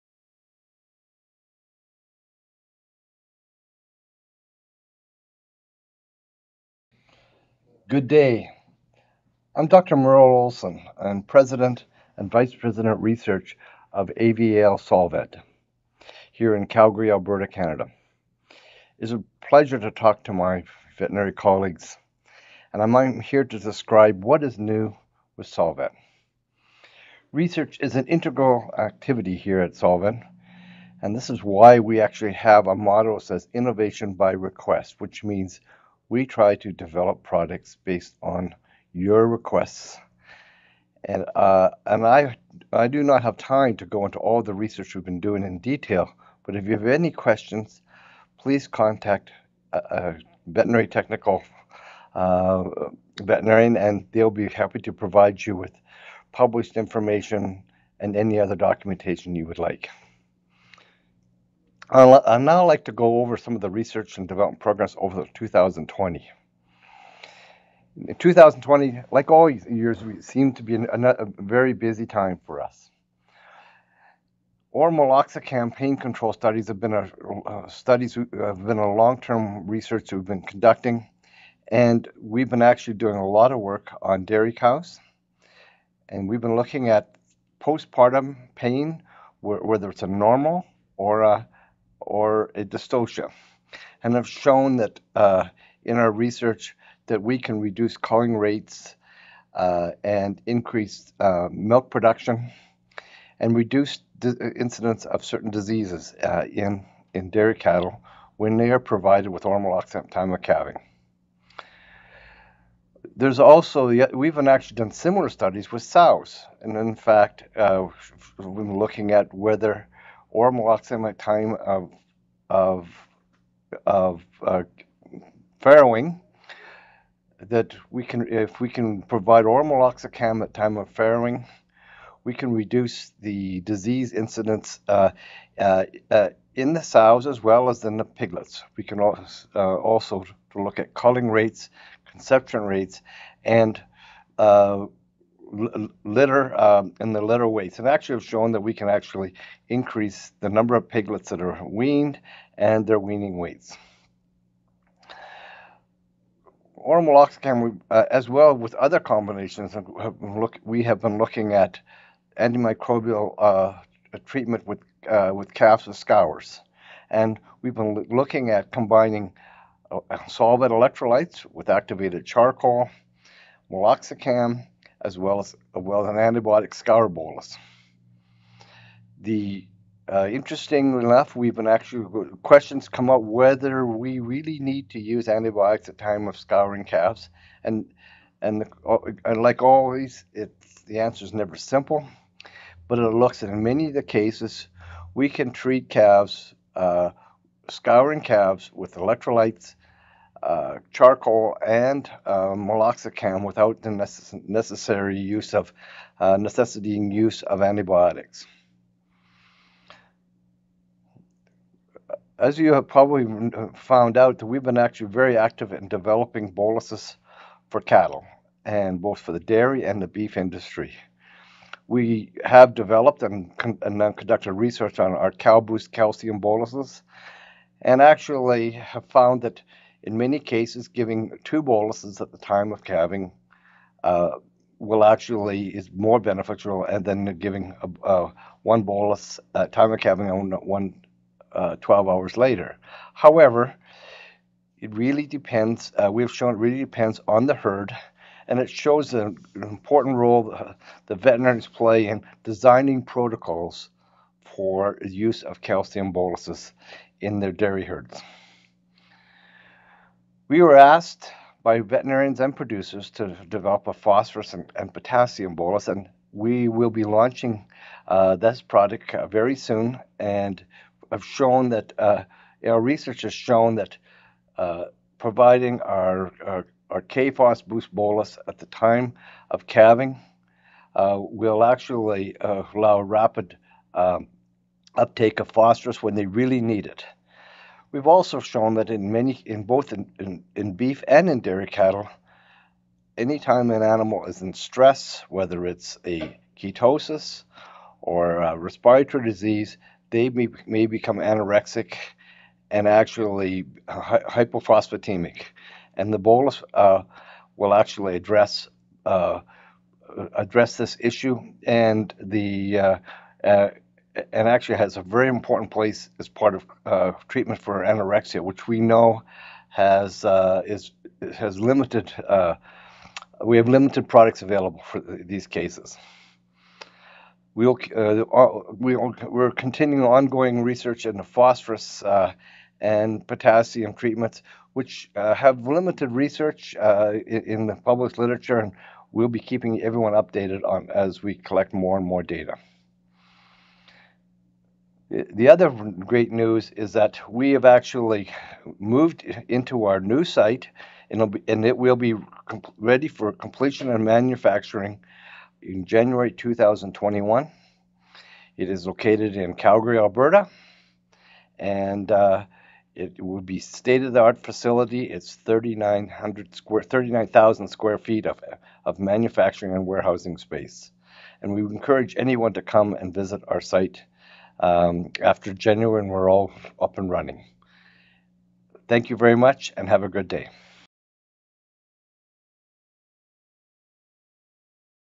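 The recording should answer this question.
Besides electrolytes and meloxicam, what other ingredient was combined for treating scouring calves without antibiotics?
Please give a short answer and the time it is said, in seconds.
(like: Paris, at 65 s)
Activated charcoal, at 171 s.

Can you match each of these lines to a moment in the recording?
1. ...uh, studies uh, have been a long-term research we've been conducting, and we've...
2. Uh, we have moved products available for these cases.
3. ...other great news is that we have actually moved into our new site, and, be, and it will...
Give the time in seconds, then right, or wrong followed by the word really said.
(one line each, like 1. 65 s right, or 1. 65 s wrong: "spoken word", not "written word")
1. 77 s right
2. 322 s wrong: "limited", not "moved"
3. 345 s right.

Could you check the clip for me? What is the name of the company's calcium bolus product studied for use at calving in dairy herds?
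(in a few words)
Cal-Boost.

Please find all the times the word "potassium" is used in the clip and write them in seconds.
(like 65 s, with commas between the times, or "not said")
264 s, 333 s.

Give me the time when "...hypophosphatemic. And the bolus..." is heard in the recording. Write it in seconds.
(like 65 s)
304 s.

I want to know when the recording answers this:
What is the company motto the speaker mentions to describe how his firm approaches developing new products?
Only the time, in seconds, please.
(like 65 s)
33 s.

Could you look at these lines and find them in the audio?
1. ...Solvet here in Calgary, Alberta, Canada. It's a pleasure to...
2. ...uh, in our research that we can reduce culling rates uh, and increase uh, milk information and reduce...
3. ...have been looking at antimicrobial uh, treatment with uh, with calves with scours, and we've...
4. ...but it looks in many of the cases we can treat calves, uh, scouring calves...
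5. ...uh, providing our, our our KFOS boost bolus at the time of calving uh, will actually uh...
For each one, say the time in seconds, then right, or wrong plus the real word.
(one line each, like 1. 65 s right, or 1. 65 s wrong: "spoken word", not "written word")
1. 14 s right
2. 95 s wrong: "production", not "information"
3. 160 s right
4. 192 s right
5. 274 s right.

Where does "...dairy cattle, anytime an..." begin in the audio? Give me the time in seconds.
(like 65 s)
291 s.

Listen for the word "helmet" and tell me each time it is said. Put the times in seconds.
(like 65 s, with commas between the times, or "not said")
not said.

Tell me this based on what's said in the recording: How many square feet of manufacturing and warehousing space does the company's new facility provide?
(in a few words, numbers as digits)
39,000 square feet.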